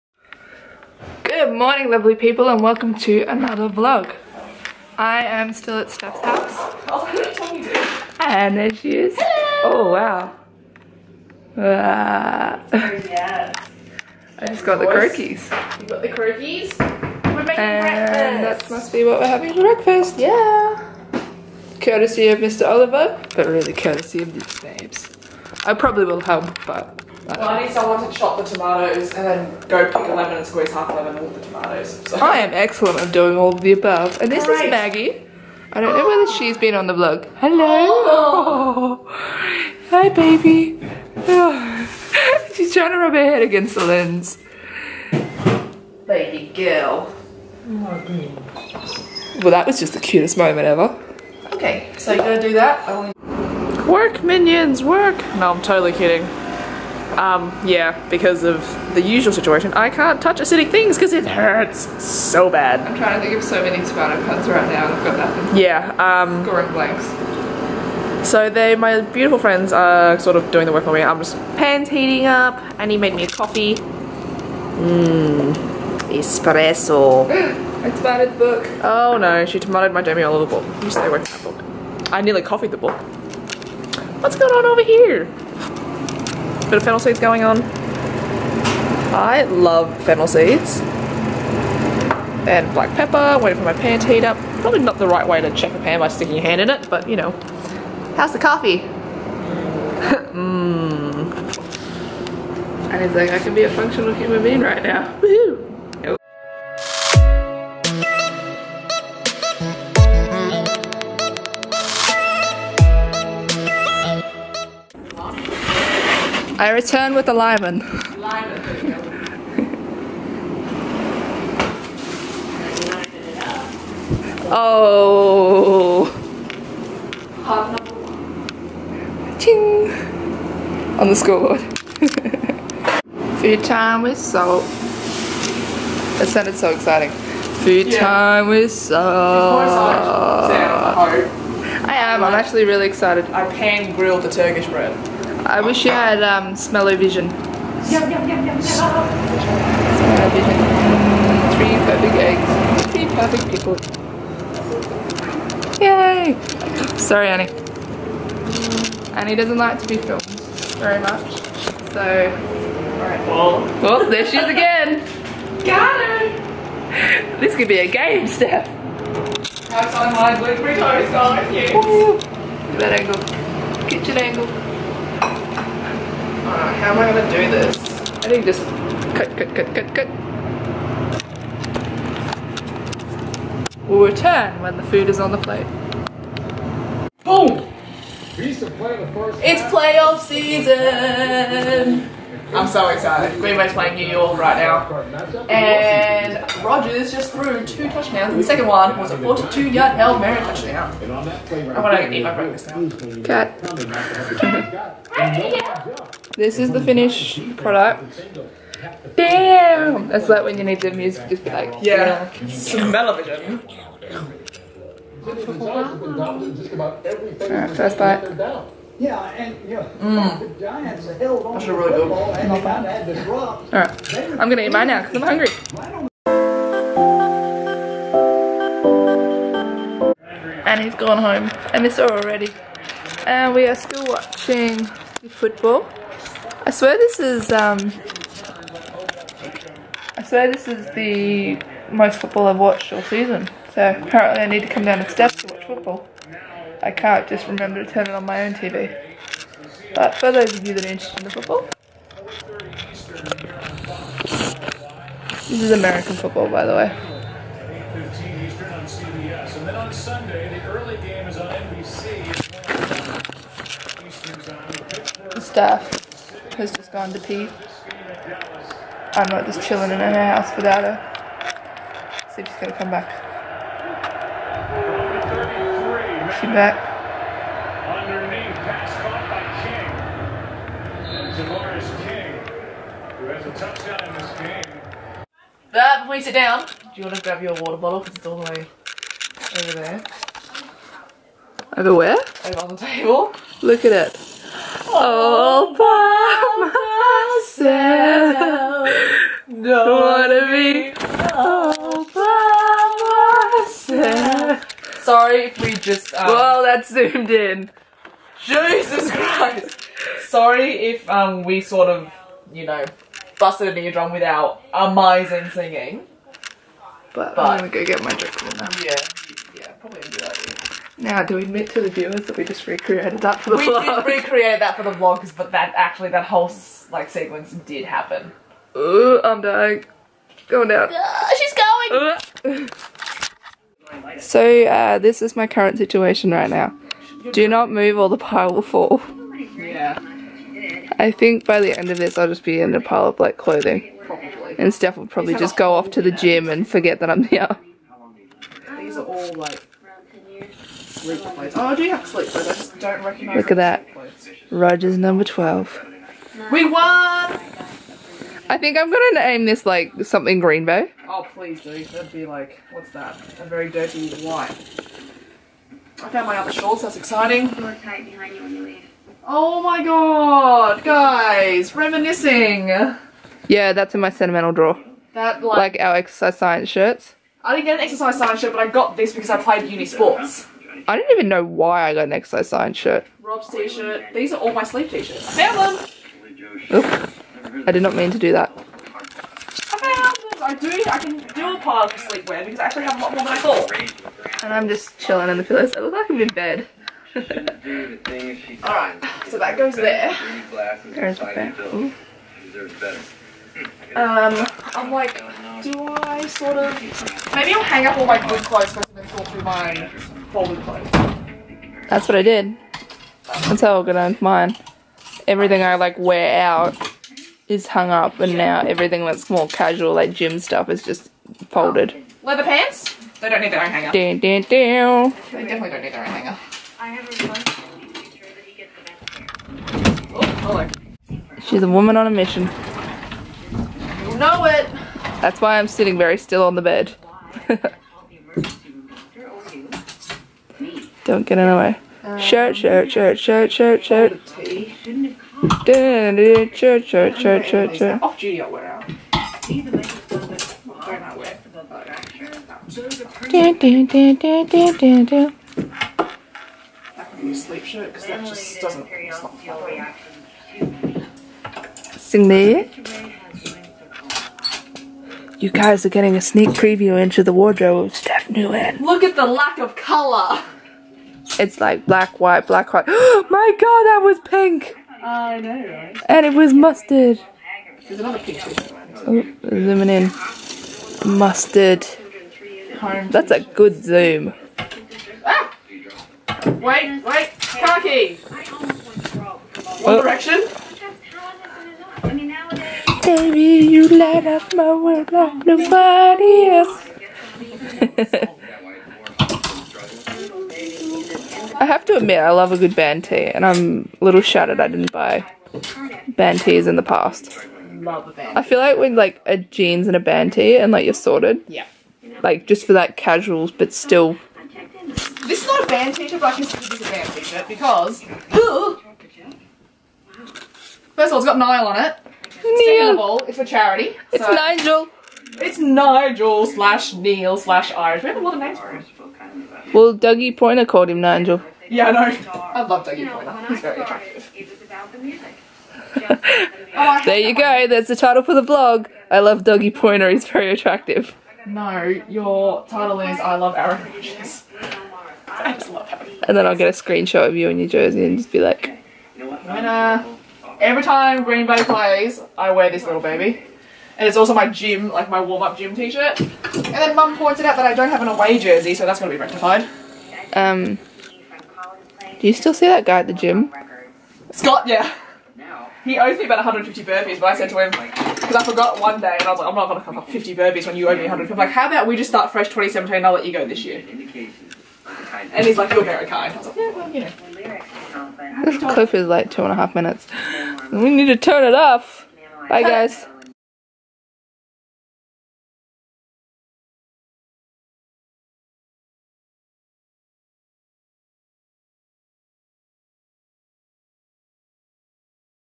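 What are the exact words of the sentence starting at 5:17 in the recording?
But, but I'm gonna go get my drink now.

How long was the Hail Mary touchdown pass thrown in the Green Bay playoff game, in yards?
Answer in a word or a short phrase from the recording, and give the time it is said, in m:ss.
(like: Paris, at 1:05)
42, at 3:19.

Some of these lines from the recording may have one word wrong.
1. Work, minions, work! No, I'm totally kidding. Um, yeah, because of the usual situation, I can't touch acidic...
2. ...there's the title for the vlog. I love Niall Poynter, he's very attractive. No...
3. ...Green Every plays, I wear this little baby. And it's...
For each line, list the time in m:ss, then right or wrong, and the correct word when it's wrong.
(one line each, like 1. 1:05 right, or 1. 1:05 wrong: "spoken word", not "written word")
1. 0:53 right
2. 8:57 wrong: "Dougie", not "Niall"
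3. 9:11 wrong: "Bay", not "Every".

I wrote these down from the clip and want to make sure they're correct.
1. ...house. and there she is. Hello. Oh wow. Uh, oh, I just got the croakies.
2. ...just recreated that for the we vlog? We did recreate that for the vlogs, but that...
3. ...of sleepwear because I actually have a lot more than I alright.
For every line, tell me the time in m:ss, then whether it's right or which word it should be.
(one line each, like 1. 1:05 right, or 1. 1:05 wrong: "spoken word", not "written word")
1. 0:06 right
2. 5:22 right
3. 6:31 wrong: "thought", not "alright".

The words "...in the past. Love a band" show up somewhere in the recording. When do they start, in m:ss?
8:26.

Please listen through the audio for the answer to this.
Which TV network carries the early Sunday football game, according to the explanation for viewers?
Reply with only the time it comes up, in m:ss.
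4:21.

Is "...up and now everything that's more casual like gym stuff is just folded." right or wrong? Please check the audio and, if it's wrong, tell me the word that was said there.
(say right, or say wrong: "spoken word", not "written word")
right.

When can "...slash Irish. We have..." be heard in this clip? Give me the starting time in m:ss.
8:47.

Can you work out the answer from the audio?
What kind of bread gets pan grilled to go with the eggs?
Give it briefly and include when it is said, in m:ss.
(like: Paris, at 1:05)
Turkish bread, at 2:24.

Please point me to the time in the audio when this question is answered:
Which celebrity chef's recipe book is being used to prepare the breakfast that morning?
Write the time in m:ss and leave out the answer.
1:20.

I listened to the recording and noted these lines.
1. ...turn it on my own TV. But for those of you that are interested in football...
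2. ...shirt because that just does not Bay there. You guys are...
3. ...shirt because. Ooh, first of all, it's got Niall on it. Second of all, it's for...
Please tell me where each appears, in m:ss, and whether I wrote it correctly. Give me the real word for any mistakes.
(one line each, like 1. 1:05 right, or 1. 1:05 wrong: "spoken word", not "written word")
1. 4:07 right
2. 7:37 wrong: "Sing", not "Bay"
3. 8:37 right.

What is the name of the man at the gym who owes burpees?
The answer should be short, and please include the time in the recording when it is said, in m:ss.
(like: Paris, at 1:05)
Scott, at 9:24.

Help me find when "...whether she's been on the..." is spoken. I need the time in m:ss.
0:36.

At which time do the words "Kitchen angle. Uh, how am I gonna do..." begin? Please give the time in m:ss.
2:53.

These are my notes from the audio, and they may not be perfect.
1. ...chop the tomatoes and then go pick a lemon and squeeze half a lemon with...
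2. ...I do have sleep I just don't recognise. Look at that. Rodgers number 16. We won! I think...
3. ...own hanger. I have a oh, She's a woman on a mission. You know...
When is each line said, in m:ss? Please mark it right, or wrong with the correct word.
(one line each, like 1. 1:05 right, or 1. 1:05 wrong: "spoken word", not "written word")
1. 0:28 right
2. 5:51 wrong: "12", not "16"
3. 7:06 right.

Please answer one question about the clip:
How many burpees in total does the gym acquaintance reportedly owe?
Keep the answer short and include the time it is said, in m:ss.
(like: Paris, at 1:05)
150, at 9:26.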